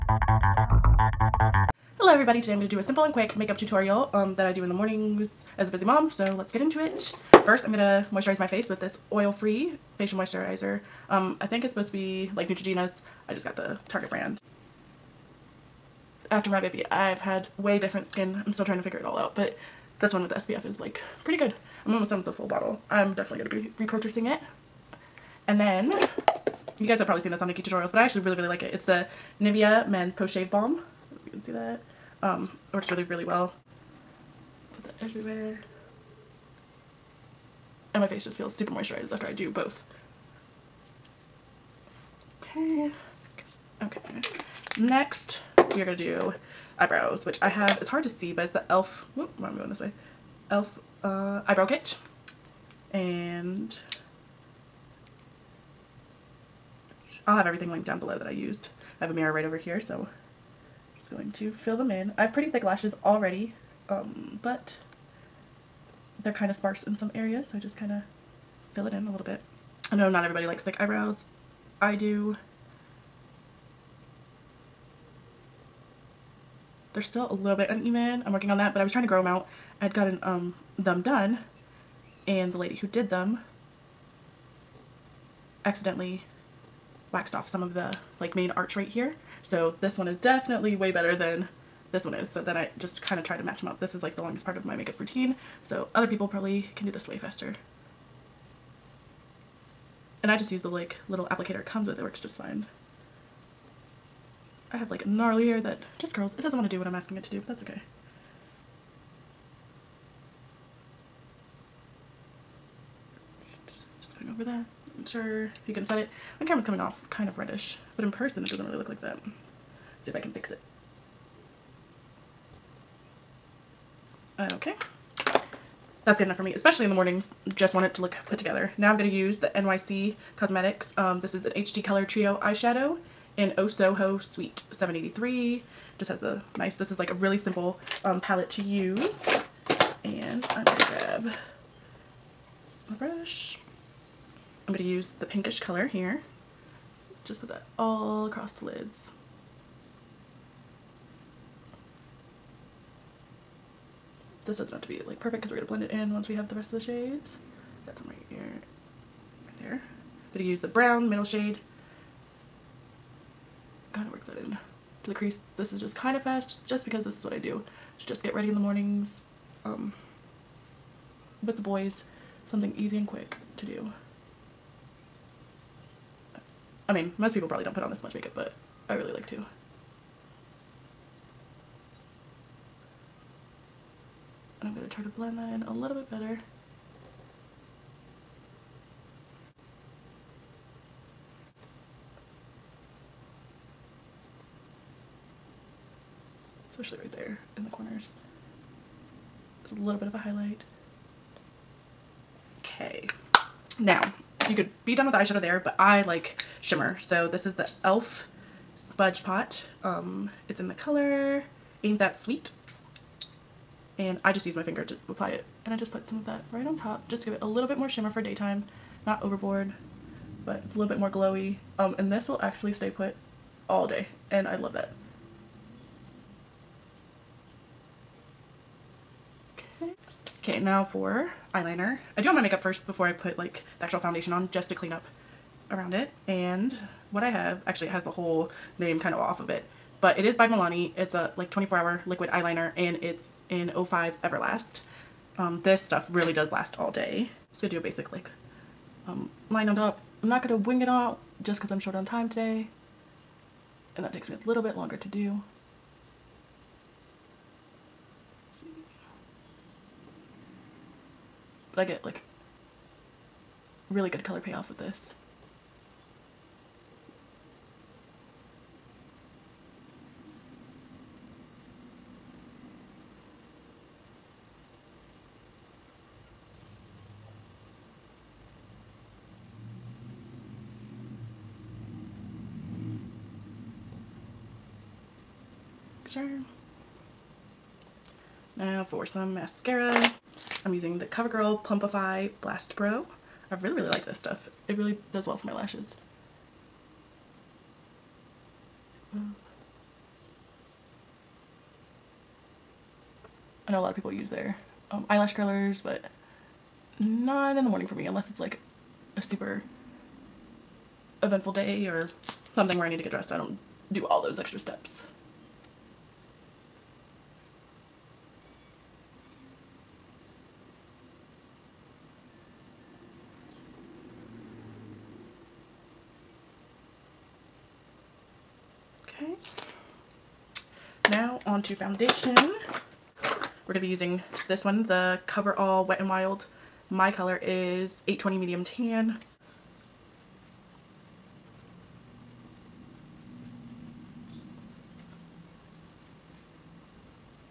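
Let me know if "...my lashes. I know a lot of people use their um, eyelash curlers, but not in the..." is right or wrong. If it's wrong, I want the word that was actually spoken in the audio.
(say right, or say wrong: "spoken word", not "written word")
right.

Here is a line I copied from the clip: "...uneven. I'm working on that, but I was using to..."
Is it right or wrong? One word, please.
wrong.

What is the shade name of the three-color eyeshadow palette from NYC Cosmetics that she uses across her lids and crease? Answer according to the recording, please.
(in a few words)
Soho Sweet 783.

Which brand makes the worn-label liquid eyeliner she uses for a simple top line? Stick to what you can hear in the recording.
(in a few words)
Milani.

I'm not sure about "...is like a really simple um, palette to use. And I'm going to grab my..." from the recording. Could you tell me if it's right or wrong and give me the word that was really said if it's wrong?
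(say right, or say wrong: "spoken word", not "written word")
right.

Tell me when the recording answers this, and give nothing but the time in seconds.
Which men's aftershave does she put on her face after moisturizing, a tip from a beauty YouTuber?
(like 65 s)
29 s.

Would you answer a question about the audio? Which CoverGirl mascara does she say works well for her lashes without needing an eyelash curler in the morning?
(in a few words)
Plumpify Blast Pro.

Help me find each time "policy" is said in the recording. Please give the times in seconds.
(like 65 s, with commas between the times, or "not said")
not said.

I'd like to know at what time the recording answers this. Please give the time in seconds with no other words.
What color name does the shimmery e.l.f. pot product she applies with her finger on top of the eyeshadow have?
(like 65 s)
211 s.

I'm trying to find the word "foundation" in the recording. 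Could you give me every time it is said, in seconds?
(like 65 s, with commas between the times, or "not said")
233 s, 331 s.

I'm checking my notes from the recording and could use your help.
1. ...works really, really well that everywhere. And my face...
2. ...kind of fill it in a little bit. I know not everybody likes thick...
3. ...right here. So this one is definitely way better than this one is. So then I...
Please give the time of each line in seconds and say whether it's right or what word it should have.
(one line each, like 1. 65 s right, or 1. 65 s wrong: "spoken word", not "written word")
1. 32 s right
2. 67 s right
3. 88 s right.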